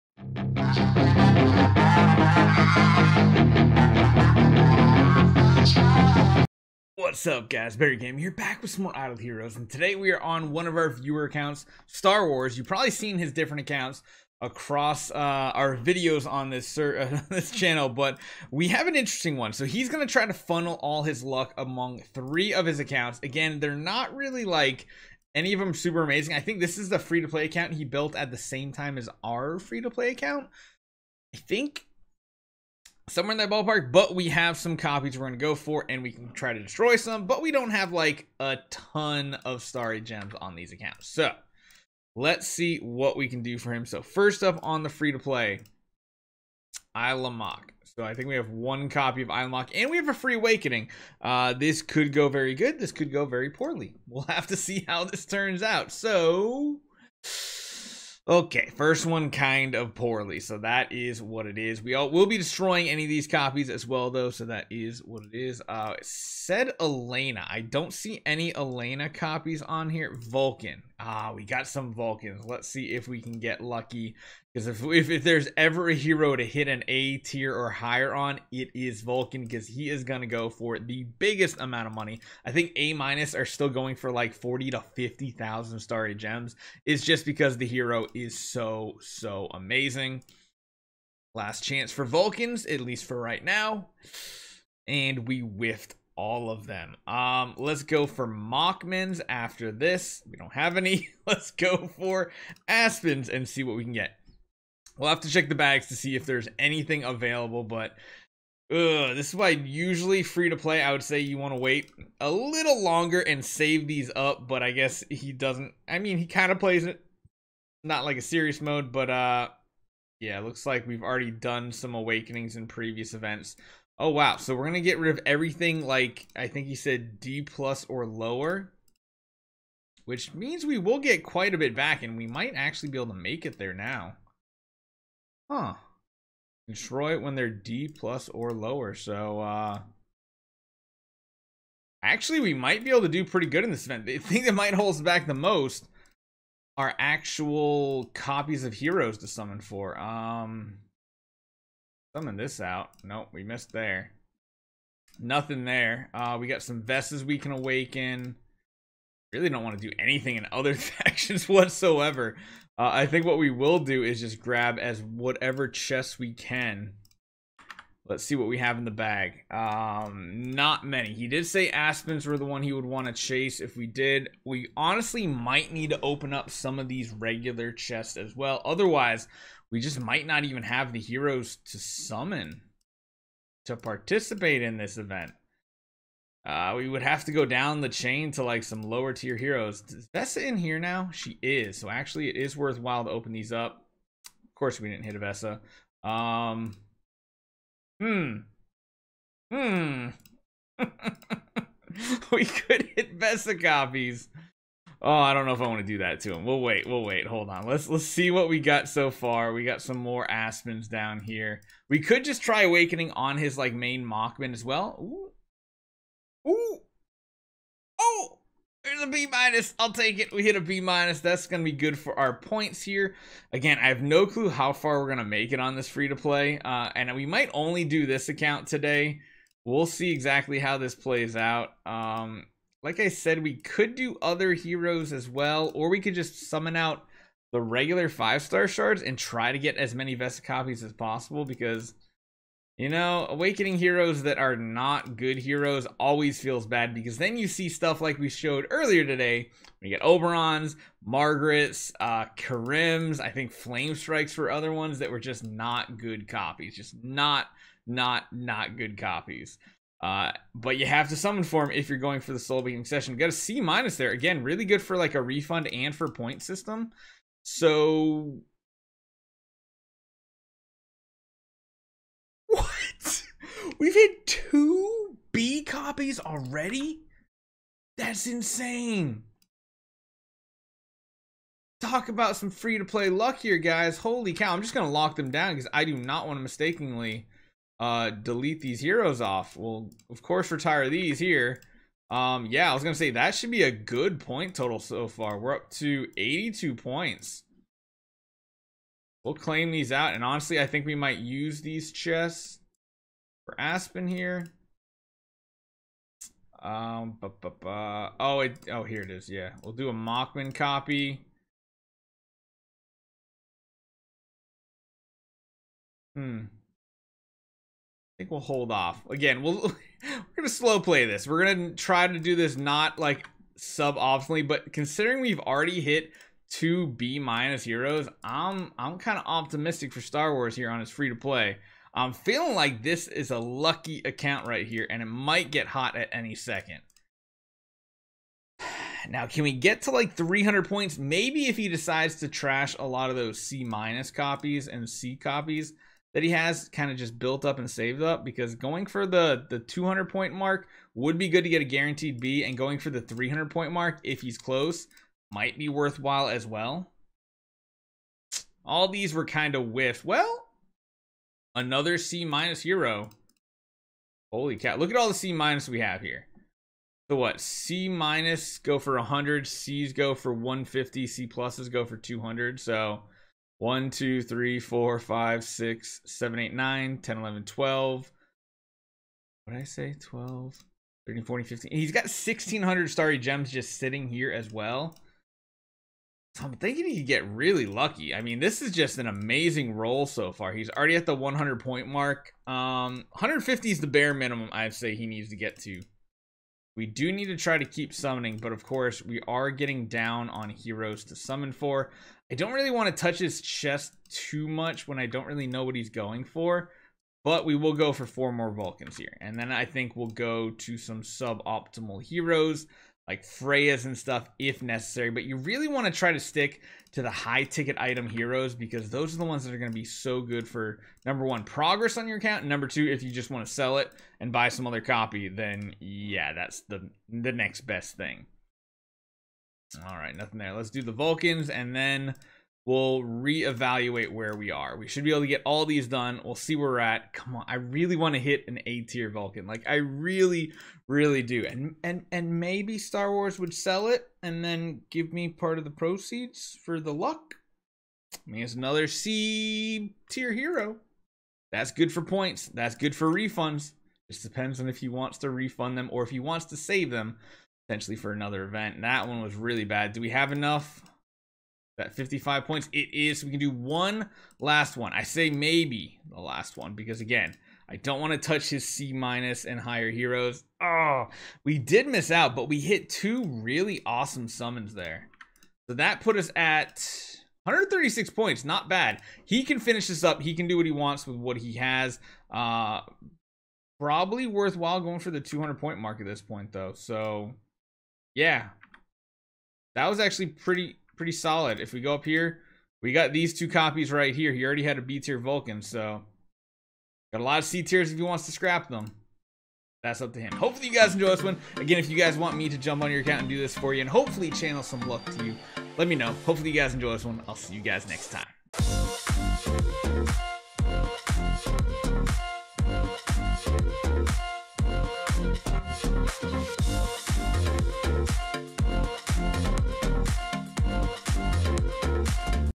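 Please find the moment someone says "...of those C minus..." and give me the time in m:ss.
5:43.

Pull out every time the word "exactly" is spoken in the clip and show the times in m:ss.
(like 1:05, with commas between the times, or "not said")
3:50.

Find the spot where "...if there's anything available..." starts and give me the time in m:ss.
1:46.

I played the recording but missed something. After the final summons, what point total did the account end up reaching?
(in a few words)
136.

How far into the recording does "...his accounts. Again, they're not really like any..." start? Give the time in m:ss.
0:22.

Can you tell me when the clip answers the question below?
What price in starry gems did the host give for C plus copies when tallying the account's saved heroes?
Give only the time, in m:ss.
6:11.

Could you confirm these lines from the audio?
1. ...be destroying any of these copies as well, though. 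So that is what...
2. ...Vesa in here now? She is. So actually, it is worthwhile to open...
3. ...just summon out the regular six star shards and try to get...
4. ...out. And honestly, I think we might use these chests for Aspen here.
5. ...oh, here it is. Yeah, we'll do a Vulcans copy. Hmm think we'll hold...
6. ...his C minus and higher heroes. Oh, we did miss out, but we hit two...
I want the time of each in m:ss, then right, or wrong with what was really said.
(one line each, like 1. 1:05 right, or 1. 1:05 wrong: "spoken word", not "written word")
1. 1:02 right
2. 3:10 right
3. 3:56 wrong: "five", not "six"
4. 4:59 right
5. 5:08 wrong: "Mockman", not "Vulcans"
6. 7:48 right.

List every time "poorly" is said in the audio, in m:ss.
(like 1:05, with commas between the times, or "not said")
0:53, 0:59.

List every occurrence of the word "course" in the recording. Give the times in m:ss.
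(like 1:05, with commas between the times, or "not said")
3:14, 4:50, 6:38.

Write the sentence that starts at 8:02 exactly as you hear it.
Uh, probably worthwhile going for the 200 point mark at this point, though.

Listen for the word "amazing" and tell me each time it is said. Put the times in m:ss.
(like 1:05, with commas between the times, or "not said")
0:26, 1:29, 6:29.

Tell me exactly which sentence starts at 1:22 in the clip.
I think A minus are still going for like 40 to 50,000 starry gems.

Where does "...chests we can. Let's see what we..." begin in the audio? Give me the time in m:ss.
2:45.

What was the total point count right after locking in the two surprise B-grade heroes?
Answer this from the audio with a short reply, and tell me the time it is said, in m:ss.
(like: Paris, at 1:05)
82, at 4:56.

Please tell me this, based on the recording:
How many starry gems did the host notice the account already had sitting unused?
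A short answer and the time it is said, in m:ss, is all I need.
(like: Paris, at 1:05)
1,600, at 6:22.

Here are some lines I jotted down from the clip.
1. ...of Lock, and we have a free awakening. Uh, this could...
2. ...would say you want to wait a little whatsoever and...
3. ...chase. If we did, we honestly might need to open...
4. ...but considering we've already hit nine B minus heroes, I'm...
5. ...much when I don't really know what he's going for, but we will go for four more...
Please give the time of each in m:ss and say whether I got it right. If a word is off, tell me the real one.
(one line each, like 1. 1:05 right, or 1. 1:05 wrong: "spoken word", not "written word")
1. 0:49 right
2. 1:50 wrong: "longer", not "whatsoever"
3. 2:53 right
4. 5:24 wrong: "two", not "nine"
5. 6:44 right.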